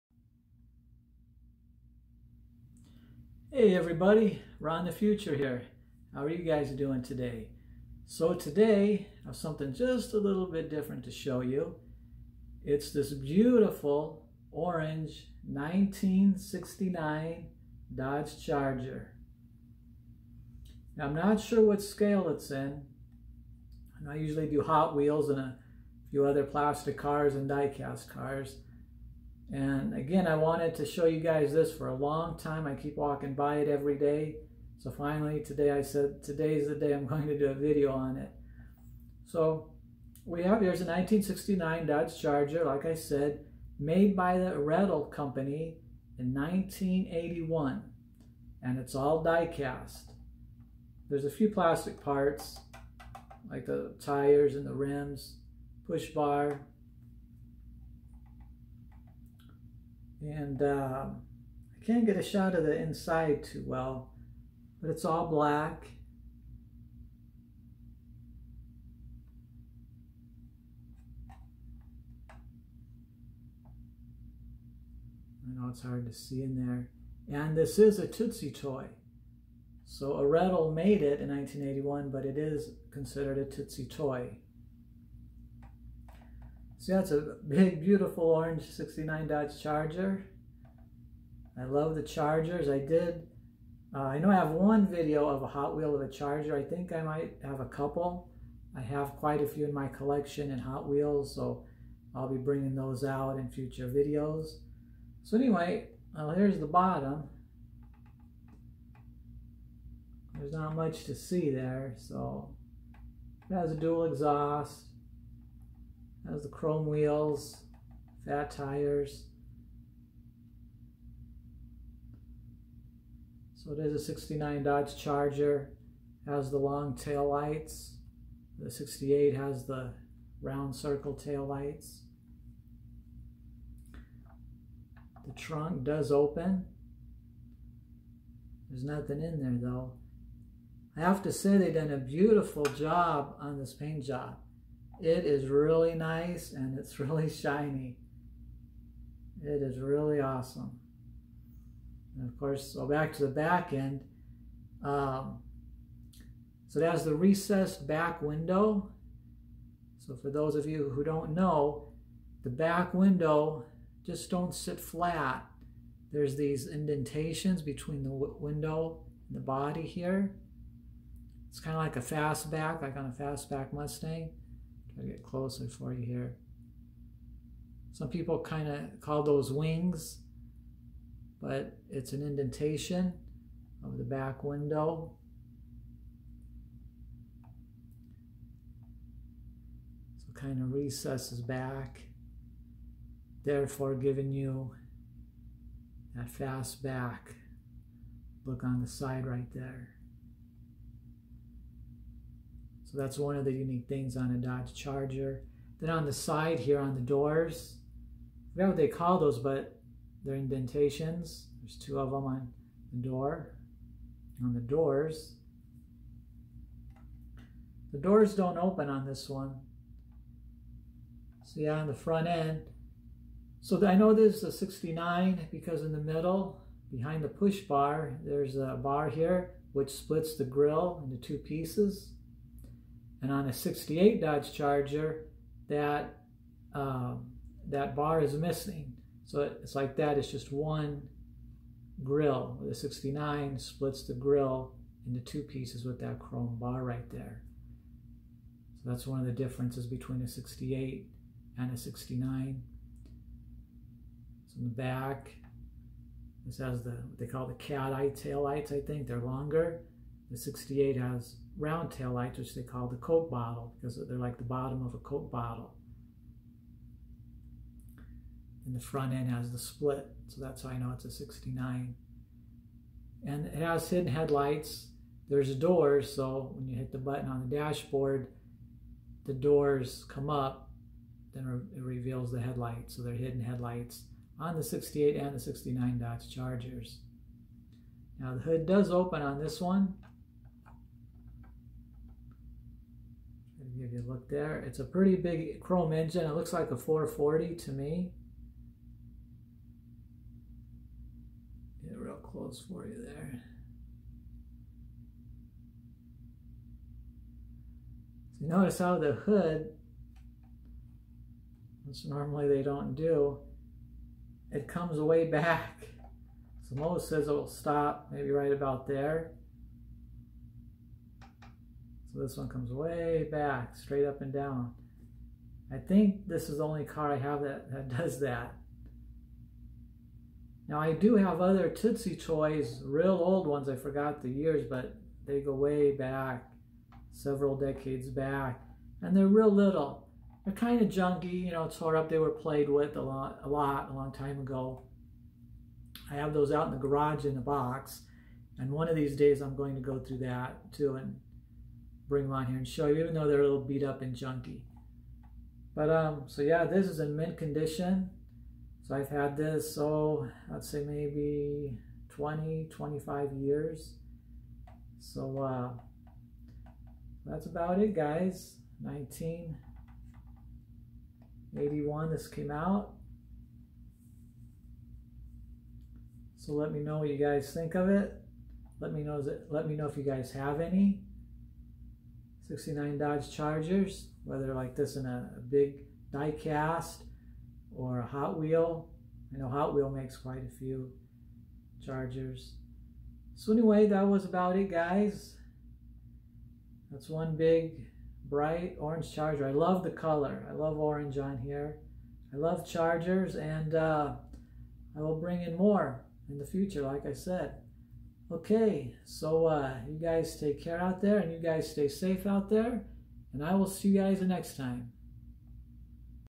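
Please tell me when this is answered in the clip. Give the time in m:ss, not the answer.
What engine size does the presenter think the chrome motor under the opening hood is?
4:56.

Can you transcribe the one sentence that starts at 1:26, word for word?
So that's a big, beautiful orange 69 Dodge Charger.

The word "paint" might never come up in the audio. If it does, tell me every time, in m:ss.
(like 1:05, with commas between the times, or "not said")
2:23.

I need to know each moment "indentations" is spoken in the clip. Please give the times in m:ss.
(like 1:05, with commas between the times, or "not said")
2:46, 3:02, 3:30.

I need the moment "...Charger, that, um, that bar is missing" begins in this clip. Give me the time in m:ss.
3:54.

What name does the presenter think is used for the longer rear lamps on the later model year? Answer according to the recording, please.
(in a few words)
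cat eye tail lights.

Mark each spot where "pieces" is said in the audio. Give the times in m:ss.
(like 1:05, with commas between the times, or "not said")
3:51, 4:05.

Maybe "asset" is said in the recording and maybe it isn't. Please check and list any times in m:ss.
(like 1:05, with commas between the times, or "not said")
not said.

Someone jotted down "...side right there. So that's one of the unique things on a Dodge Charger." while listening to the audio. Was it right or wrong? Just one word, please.
right.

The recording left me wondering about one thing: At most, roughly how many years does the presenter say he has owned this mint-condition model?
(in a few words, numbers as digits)
25.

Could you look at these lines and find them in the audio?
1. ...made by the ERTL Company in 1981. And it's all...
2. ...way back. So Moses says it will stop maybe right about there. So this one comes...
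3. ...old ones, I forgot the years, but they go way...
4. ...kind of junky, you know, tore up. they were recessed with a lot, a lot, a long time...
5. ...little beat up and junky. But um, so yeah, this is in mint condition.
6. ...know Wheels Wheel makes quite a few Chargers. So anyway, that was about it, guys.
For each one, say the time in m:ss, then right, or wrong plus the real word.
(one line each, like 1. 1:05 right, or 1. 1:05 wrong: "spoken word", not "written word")
1. 0:43 right
2. 5:14 right
3. 5:33 right
4. 5:40 wrong: "played", not "recessed"
5. 5:53 right
6. 6:29 wrong: "Hot", not "Wheels".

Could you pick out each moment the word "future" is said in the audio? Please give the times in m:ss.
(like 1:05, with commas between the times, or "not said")
0:04, 1:43, 6:46.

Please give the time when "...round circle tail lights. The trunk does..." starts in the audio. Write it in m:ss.
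2:10.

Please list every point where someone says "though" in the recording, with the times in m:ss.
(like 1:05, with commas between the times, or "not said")
2:19, 5:53.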